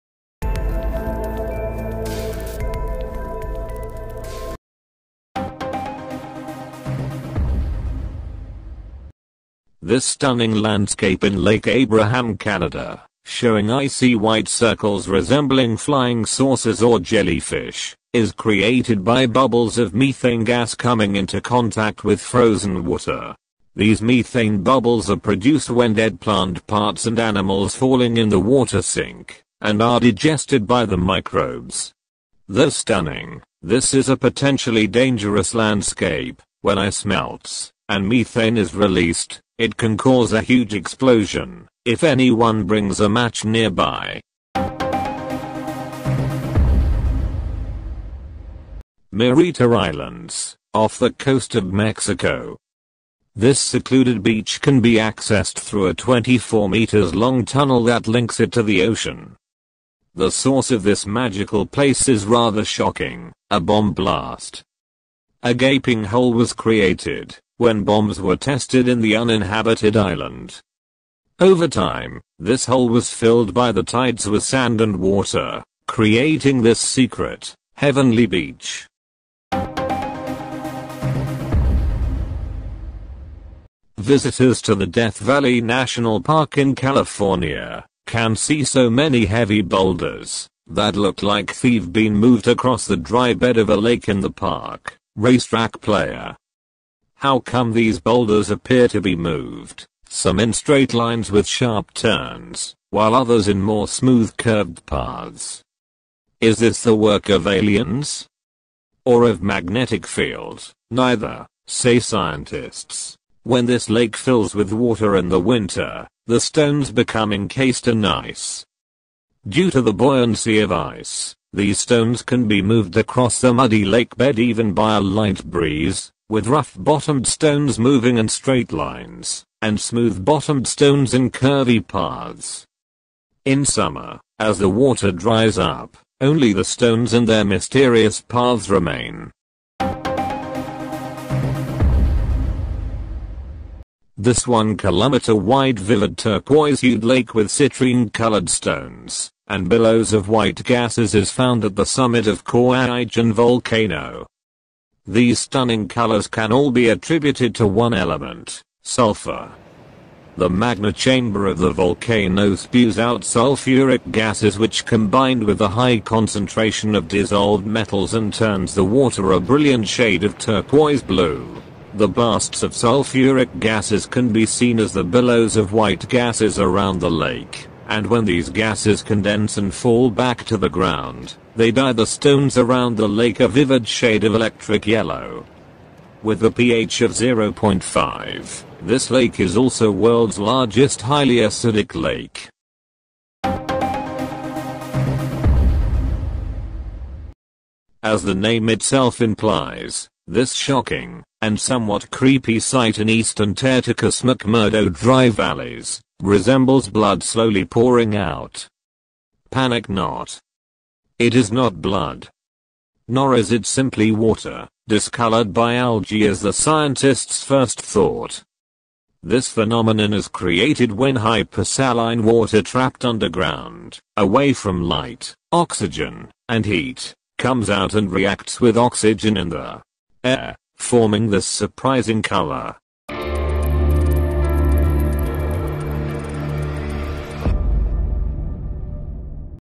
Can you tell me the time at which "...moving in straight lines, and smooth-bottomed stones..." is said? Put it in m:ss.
2:07.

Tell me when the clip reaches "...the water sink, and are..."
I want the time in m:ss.
0:28.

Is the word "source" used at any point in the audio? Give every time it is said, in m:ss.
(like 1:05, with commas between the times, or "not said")
1:00.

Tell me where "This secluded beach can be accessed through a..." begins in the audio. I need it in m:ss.
0:53.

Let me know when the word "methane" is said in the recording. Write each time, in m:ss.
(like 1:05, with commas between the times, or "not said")
0:19, 0:24, 0:38.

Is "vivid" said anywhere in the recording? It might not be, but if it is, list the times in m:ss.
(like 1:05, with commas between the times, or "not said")
2:25, 3:03.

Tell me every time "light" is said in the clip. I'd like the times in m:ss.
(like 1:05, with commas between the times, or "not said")
2:05, 3:44.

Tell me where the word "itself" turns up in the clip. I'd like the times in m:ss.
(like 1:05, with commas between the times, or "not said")
3:18.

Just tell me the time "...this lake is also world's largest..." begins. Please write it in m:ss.
3:08.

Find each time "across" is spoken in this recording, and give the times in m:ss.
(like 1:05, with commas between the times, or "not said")
1:32, 2:02.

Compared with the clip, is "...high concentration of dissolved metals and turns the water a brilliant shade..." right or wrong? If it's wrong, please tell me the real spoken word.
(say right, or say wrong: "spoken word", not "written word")
right.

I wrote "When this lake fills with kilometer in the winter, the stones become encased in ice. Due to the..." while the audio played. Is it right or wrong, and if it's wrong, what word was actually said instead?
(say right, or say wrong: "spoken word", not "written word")
wrong: "water", not "kilometer".